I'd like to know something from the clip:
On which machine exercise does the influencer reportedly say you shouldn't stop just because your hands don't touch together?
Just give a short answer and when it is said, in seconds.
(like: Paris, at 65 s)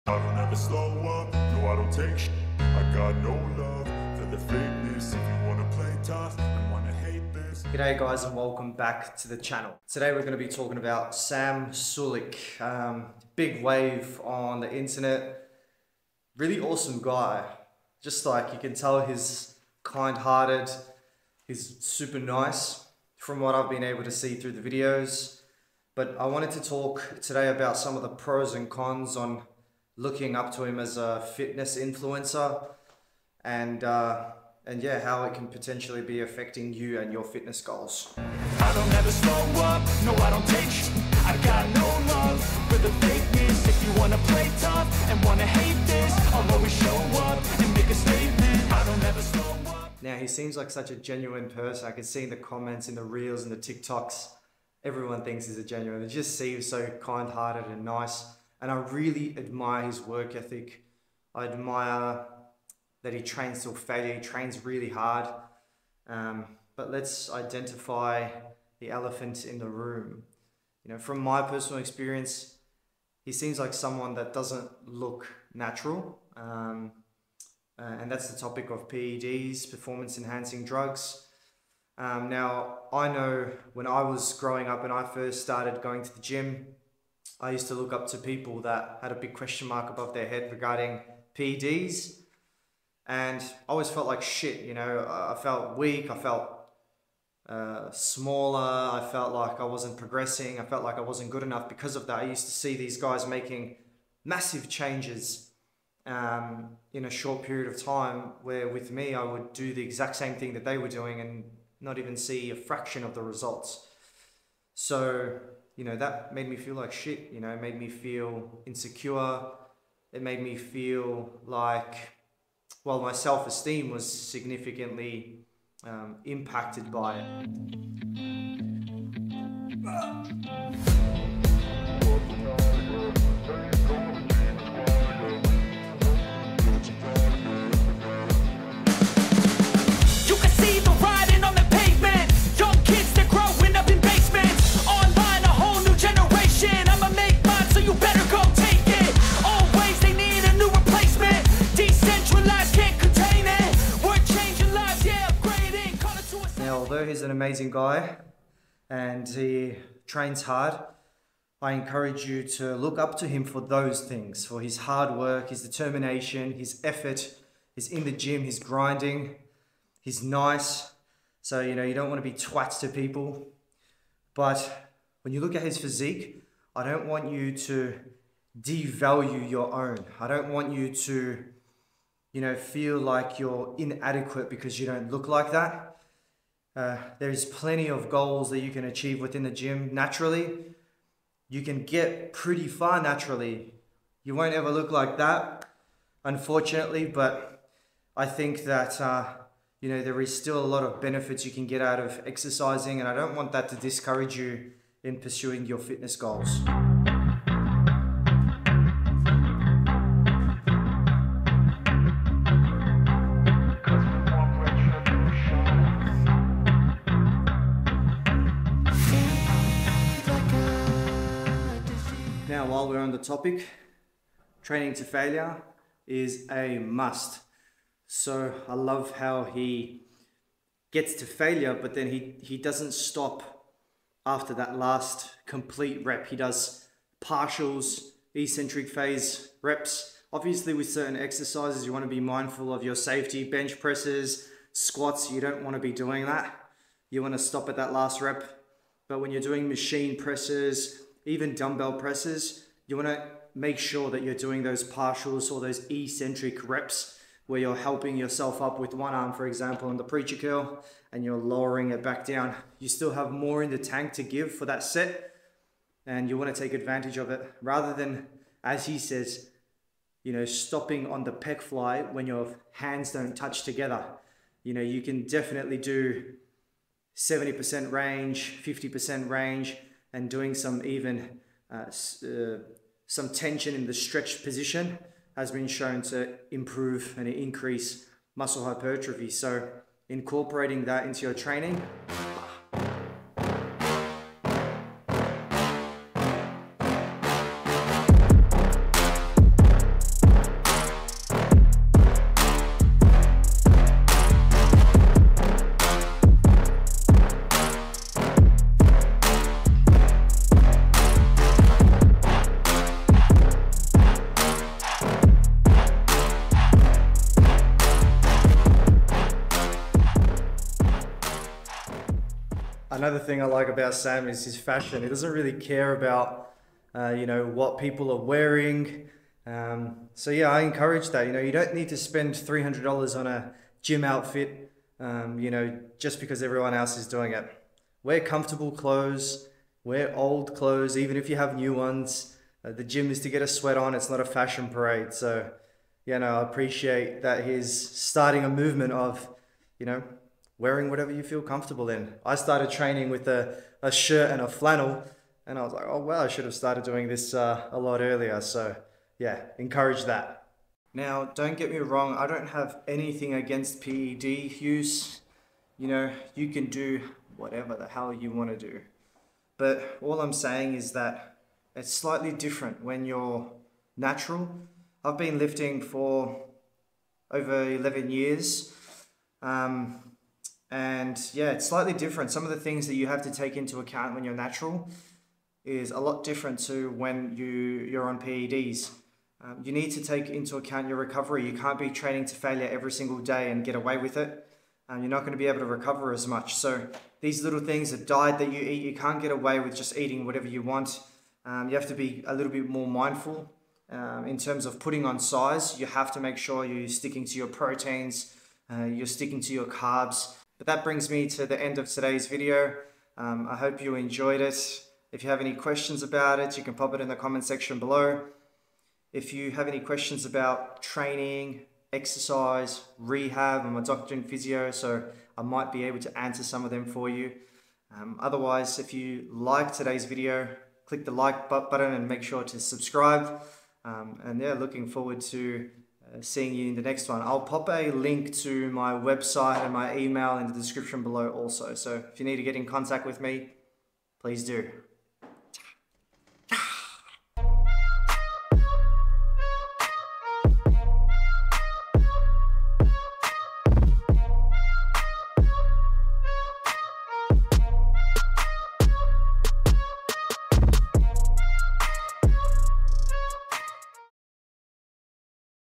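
pec fly, at 271 s.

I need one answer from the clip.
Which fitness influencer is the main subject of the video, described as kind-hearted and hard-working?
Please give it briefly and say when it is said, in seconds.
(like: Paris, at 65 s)
Sam Sulek, at 11 s.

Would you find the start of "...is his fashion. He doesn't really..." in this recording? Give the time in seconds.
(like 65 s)
324 s.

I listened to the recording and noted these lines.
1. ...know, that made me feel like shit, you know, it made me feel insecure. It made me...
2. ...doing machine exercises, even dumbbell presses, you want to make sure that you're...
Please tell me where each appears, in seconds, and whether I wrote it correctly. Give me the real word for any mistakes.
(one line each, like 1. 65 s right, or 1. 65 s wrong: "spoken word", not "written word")
1. 115 s right
2. 249 s wrong: "presses", not "exercises".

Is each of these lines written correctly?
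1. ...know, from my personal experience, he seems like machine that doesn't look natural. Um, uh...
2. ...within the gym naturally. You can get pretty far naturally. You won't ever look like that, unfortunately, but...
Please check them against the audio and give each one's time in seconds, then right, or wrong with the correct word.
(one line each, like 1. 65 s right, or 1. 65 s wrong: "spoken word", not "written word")
1. 70 s wrong: "someone", not "machine"
2. 189 s right.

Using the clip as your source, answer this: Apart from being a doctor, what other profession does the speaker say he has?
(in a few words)
physio.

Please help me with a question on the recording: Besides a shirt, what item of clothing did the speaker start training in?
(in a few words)
a flannel.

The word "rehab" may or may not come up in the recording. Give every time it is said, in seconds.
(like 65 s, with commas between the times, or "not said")
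422 s.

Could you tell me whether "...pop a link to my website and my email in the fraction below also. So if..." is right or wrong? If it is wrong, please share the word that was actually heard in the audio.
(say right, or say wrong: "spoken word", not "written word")
wrong: "description", not "fraction".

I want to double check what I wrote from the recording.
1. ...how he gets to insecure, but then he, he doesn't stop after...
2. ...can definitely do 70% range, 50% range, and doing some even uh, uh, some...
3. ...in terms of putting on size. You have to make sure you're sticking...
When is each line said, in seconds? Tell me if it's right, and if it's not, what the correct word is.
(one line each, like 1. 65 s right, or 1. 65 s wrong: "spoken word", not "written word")
1. 229 s wrong: "failure", not "insecure"
2. 275 s right
3. 404 s right.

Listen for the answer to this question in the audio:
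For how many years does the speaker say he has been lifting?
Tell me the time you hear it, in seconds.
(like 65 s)
377 s.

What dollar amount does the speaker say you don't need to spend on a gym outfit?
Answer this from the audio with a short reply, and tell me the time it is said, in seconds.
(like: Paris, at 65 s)
300 dollars, at 332 s.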